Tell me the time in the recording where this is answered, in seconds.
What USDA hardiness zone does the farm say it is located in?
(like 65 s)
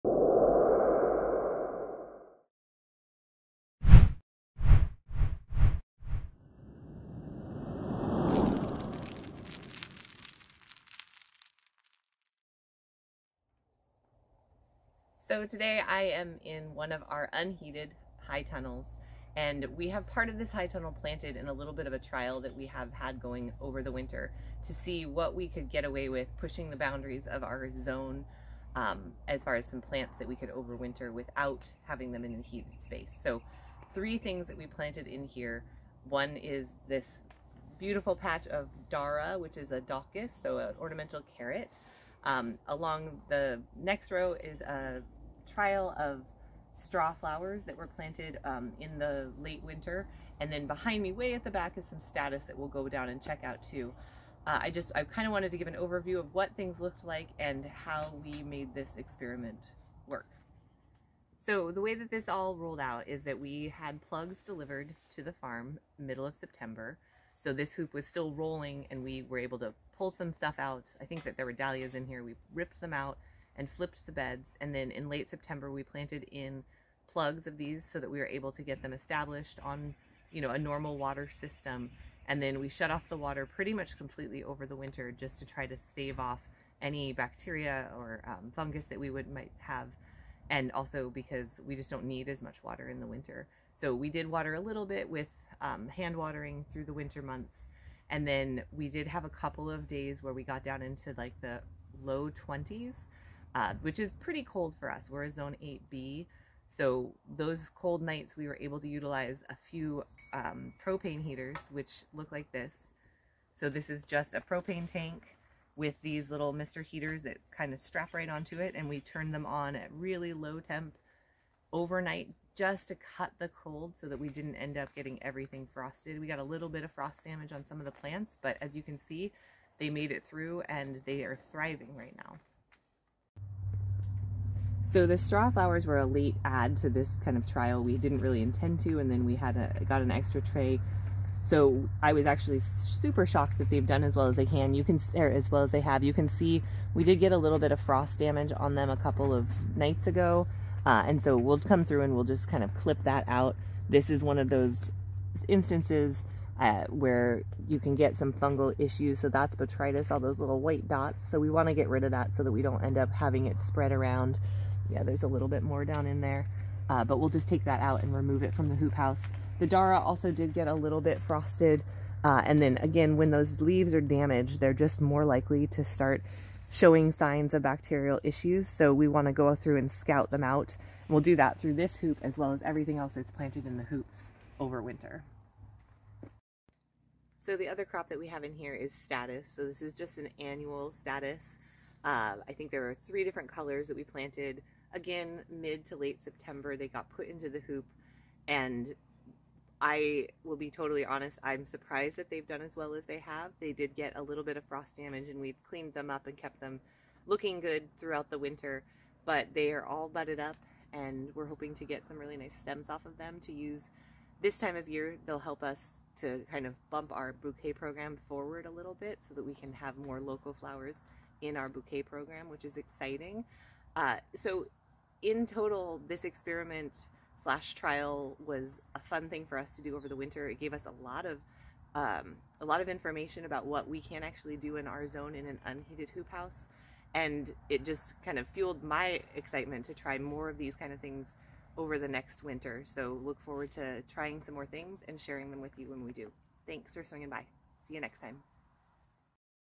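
105 s.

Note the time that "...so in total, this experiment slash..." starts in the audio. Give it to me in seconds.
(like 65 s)
224 s.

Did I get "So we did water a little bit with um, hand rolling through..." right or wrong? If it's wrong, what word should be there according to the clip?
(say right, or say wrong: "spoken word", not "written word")
wrong: "watering", not "rolling".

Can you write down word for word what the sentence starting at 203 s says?
They did get a little bit of frost damage, and we've cleaned them up and kept them looking good throughout the winter.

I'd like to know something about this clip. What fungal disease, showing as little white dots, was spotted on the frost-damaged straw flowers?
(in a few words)
botrytis.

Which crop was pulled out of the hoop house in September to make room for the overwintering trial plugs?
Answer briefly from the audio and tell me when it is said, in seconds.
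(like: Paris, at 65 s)
dahlias, at 71 s.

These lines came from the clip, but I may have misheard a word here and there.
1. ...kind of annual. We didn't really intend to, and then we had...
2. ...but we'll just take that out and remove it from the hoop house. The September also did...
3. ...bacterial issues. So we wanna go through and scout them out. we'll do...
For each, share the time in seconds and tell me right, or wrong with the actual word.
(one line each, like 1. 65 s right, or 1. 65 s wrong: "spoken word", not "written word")
1. 137 s wrong: "trial", not "annual"
2. 167 s wrong: "Dara", not "September"
3. 177 s right.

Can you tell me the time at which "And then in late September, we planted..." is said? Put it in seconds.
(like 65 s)
74 s.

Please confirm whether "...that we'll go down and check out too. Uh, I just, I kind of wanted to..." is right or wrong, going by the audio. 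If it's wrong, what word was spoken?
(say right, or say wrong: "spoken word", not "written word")
right.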